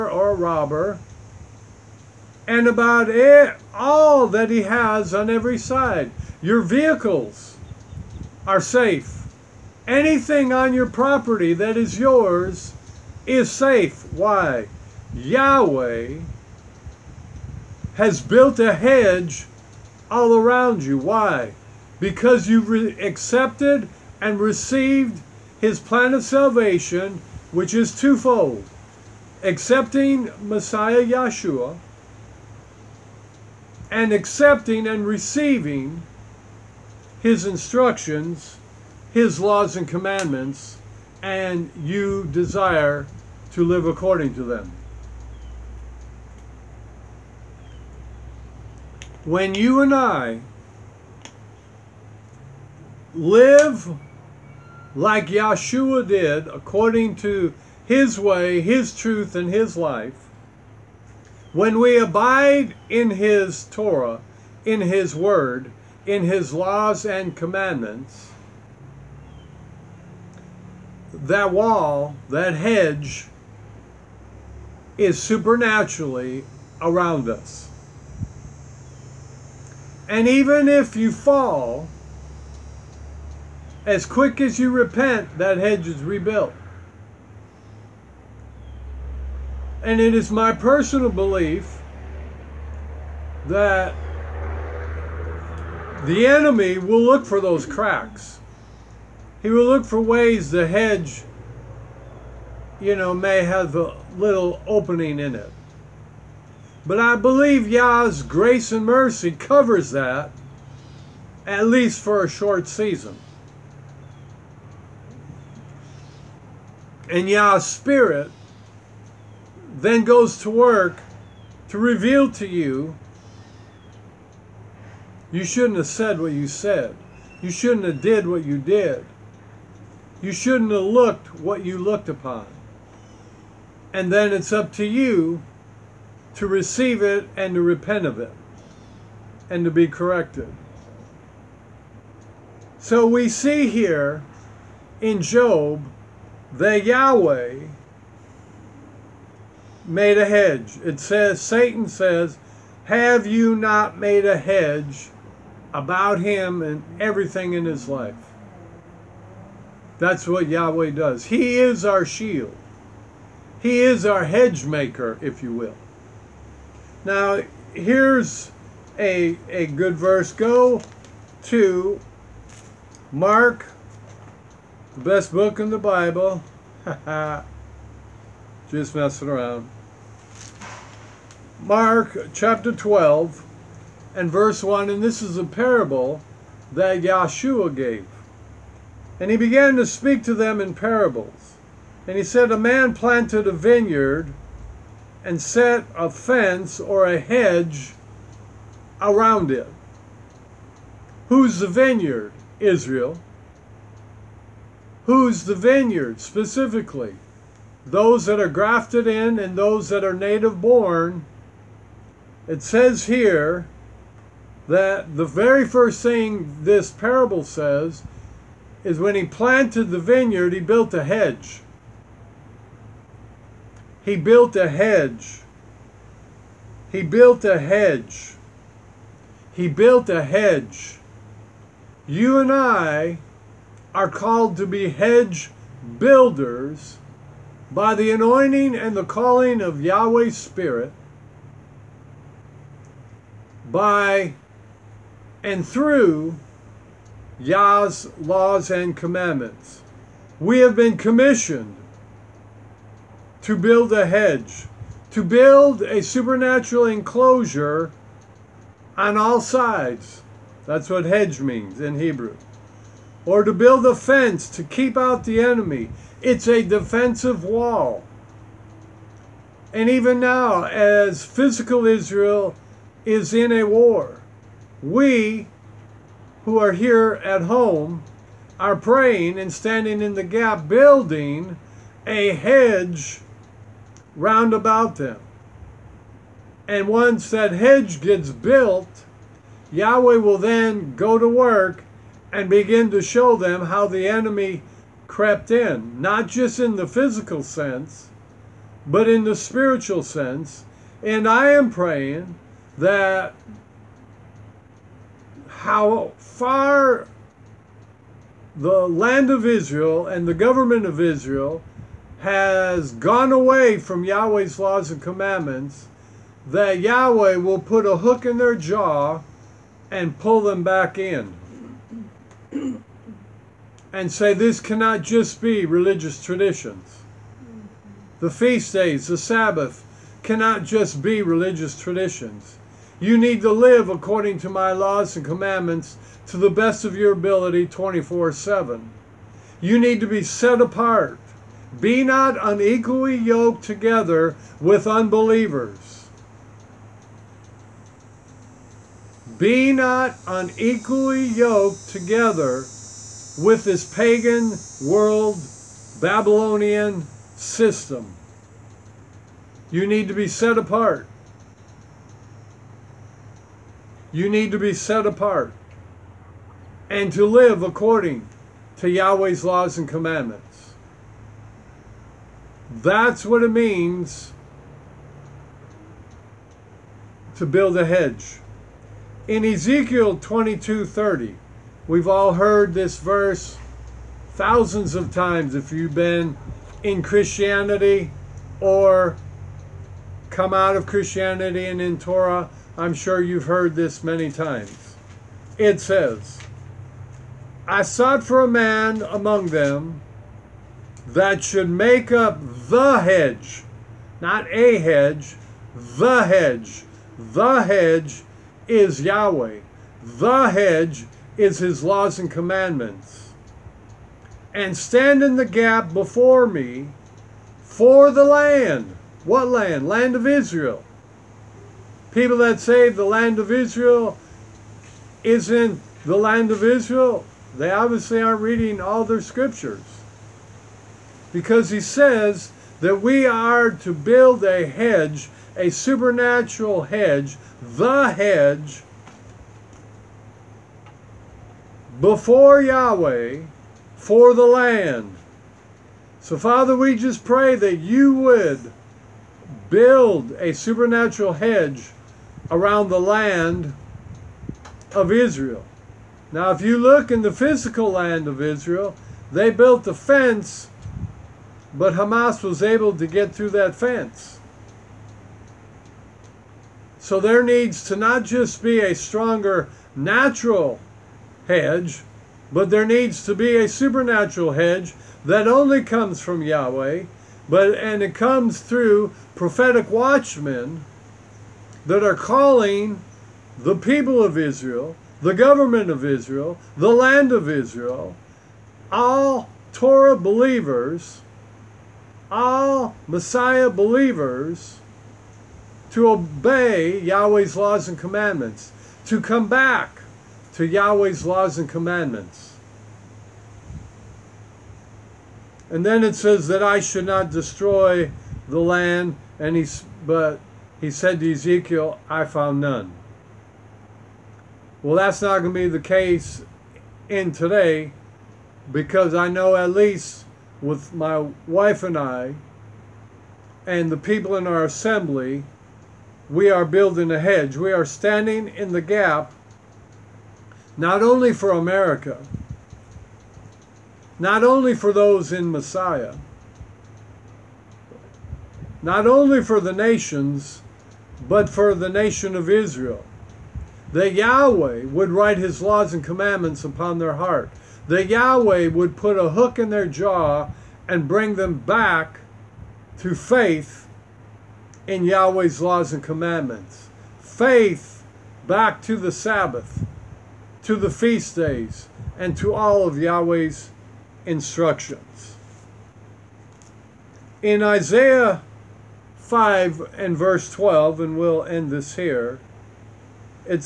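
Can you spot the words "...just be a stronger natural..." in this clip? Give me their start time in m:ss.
7:48.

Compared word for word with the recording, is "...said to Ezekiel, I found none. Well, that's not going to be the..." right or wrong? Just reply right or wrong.
right.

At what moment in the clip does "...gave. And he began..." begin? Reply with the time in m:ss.
3:07.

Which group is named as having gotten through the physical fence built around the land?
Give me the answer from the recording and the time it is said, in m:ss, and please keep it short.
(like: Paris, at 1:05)
Hamas, at 7:41.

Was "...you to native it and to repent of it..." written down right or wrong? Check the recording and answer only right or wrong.
wrong.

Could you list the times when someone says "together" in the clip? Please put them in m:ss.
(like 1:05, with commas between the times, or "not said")
5:43, 5:51.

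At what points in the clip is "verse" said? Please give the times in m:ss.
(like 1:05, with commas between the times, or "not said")
2:49, 3:04, 6:22, 9:30.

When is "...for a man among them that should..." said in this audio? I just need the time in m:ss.
6:38.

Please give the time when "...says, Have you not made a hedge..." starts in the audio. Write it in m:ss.
2:31.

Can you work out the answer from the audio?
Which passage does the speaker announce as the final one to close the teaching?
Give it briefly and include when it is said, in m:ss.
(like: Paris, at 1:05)
Isaiah 5:12, at 9:27.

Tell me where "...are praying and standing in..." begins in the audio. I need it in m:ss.
4:38.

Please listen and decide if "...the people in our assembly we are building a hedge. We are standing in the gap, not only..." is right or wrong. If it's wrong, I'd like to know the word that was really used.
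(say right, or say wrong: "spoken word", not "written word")
right.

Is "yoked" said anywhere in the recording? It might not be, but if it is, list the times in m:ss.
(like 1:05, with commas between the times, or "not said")
5:43, 5:51.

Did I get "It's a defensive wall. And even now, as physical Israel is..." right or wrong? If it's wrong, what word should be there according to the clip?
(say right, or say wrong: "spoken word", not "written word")
right.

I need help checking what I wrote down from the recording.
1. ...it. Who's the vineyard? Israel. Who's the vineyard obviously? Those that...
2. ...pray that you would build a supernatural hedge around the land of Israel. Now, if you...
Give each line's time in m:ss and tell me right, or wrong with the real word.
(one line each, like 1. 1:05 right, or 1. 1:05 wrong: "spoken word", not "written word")
1. 3:19 wrong: "specifically", not "obviously"
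2. 7:27 right.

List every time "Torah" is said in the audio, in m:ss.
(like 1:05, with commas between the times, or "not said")
1:03, 6:31, 8:09.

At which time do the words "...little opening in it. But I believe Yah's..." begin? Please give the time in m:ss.
1:44.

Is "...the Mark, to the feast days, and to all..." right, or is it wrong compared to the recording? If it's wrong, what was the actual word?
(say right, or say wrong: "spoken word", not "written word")
wrong: "Sabbath", not "Mark".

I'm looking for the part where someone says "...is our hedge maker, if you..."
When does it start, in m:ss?
2:43.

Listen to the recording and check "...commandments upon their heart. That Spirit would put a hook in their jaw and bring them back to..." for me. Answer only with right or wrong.
wrong.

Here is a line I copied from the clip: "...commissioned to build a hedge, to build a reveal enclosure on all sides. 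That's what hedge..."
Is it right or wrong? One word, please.
wrong.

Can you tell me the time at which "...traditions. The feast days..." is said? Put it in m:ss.
5:26.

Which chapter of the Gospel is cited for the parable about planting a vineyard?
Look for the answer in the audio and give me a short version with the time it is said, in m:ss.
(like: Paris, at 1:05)
12, at 3:01.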